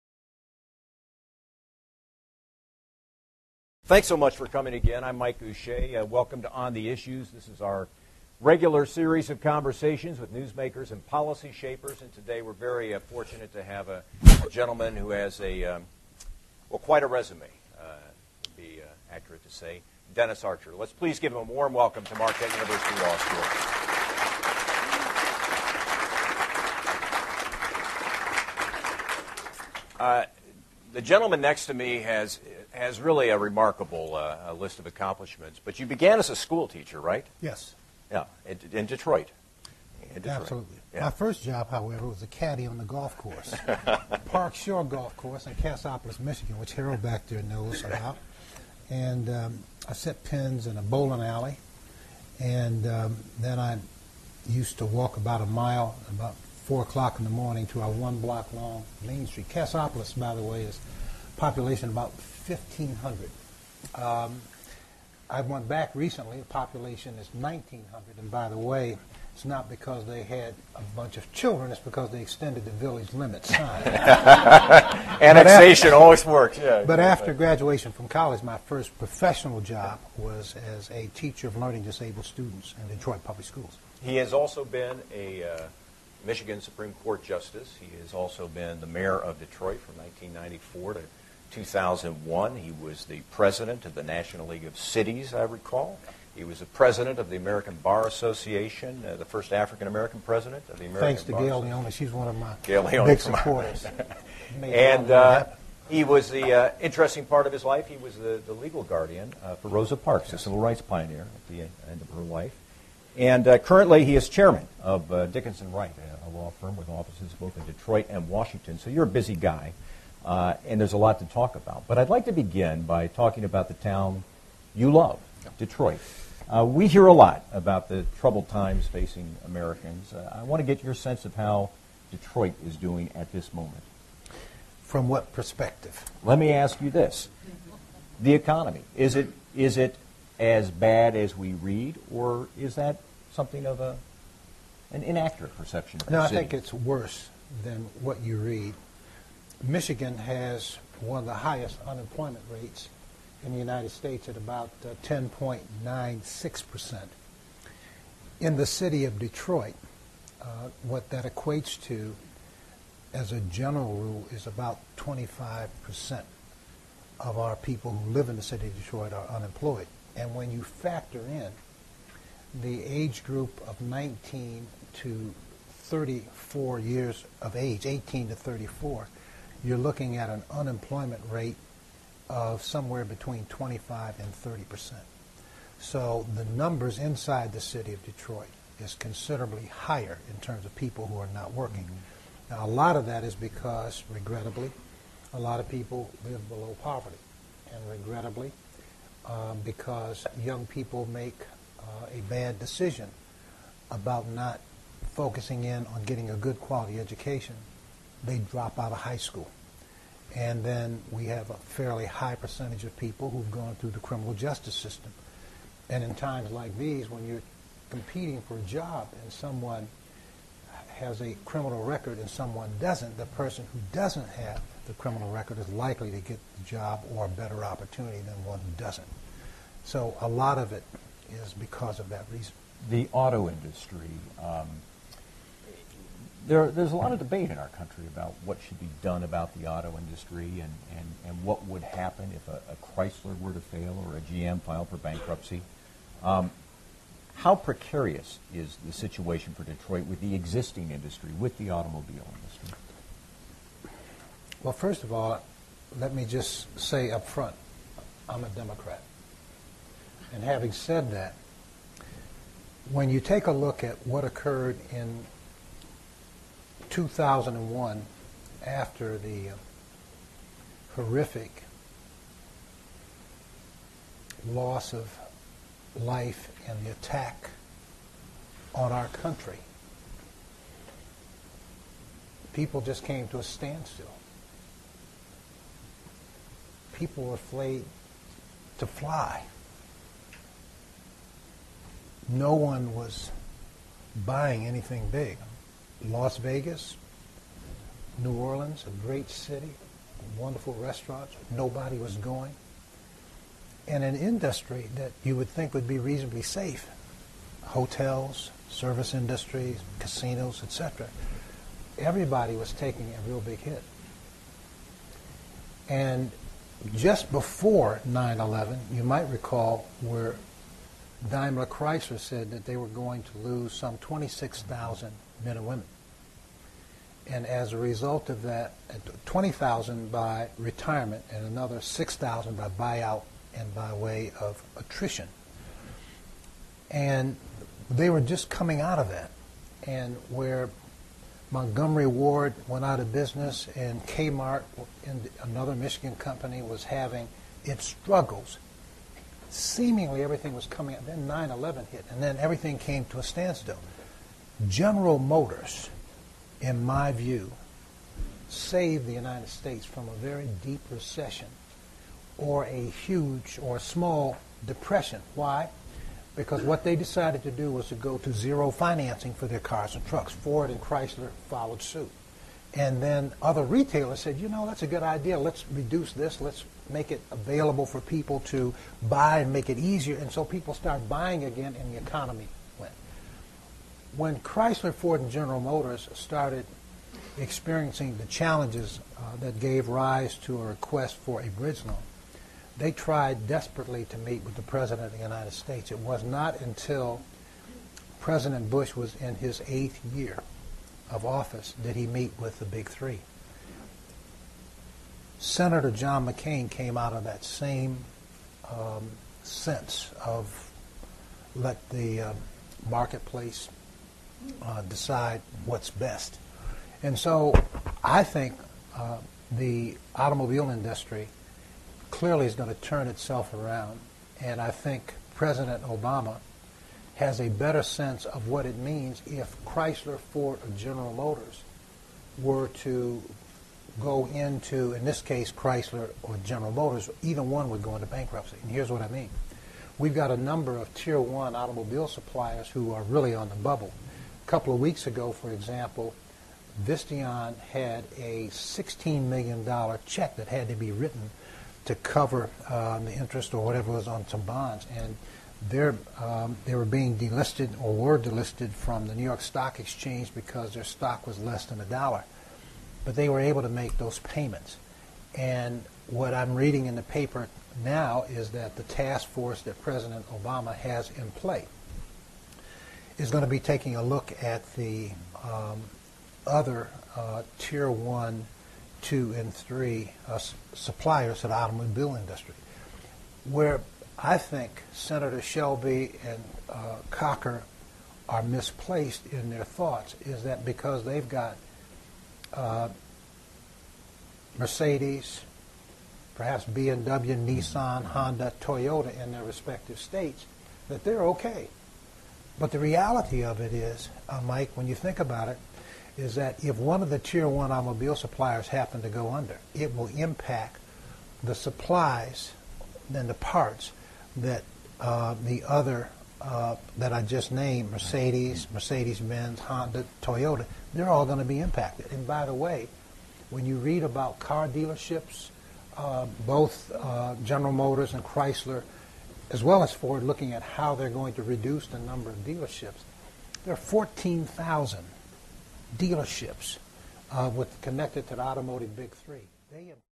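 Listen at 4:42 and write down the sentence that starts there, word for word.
People just came to a standstill.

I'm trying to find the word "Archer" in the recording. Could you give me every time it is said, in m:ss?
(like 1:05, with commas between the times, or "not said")
0:20.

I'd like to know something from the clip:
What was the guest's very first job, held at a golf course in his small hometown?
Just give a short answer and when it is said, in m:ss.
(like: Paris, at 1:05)
Caddy, at 0:42.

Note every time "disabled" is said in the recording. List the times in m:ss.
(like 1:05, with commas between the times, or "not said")
1:21.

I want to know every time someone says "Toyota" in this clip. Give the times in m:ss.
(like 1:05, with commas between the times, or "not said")
8:18, 8:40.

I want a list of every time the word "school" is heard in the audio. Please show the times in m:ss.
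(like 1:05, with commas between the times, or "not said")
0:23, 0:36, 1:23, 3:29.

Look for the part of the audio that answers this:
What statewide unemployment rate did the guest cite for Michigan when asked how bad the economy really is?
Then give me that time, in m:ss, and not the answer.
2:35.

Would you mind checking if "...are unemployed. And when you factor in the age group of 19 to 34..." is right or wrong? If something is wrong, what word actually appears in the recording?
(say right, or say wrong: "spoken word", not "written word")
right.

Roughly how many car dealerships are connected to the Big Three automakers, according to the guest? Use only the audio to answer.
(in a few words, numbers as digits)
14,000.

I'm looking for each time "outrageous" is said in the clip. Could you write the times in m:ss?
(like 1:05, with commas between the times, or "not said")
not said.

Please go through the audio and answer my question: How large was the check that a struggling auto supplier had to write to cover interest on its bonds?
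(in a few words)
$16 million.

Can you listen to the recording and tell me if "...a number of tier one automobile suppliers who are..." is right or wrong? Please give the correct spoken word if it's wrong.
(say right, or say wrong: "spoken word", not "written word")
right.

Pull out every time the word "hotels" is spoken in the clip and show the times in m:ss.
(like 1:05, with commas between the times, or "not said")
5:07.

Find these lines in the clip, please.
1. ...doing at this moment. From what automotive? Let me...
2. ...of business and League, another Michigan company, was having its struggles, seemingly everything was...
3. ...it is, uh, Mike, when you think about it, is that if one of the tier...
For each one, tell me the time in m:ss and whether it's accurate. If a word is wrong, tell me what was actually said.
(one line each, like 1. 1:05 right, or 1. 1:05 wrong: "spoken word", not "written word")
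1. 2:12 wrong: "perspective", not "automotive"
2. 5:42 wrong: "Kmart", not "League"
3. 8:23 right.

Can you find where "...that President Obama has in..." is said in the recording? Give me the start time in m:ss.
7:49.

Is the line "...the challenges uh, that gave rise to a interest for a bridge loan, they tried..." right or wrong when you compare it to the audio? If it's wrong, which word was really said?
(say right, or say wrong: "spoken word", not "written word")
wrong: "request", not "interest".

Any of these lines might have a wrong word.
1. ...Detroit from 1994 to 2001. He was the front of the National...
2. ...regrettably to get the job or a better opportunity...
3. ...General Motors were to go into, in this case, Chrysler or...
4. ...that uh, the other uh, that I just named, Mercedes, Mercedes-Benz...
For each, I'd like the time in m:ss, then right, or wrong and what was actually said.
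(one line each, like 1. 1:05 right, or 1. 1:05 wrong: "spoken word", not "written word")
1. 1:29 wrong: "president", not "front"
2. 3:45 wrong: "likely", not "regrettably"
3. 7:10 right
4. 8:34 right.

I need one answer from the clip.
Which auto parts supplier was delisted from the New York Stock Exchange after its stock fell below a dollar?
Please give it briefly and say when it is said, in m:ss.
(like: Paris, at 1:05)
Visteon, at 7:26.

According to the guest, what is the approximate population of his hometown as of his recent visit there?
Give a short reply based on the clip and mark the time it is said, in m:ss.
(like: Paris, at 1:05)
1,900, at 1:07.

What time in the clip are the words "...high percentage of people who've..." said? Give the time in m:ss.
3:32.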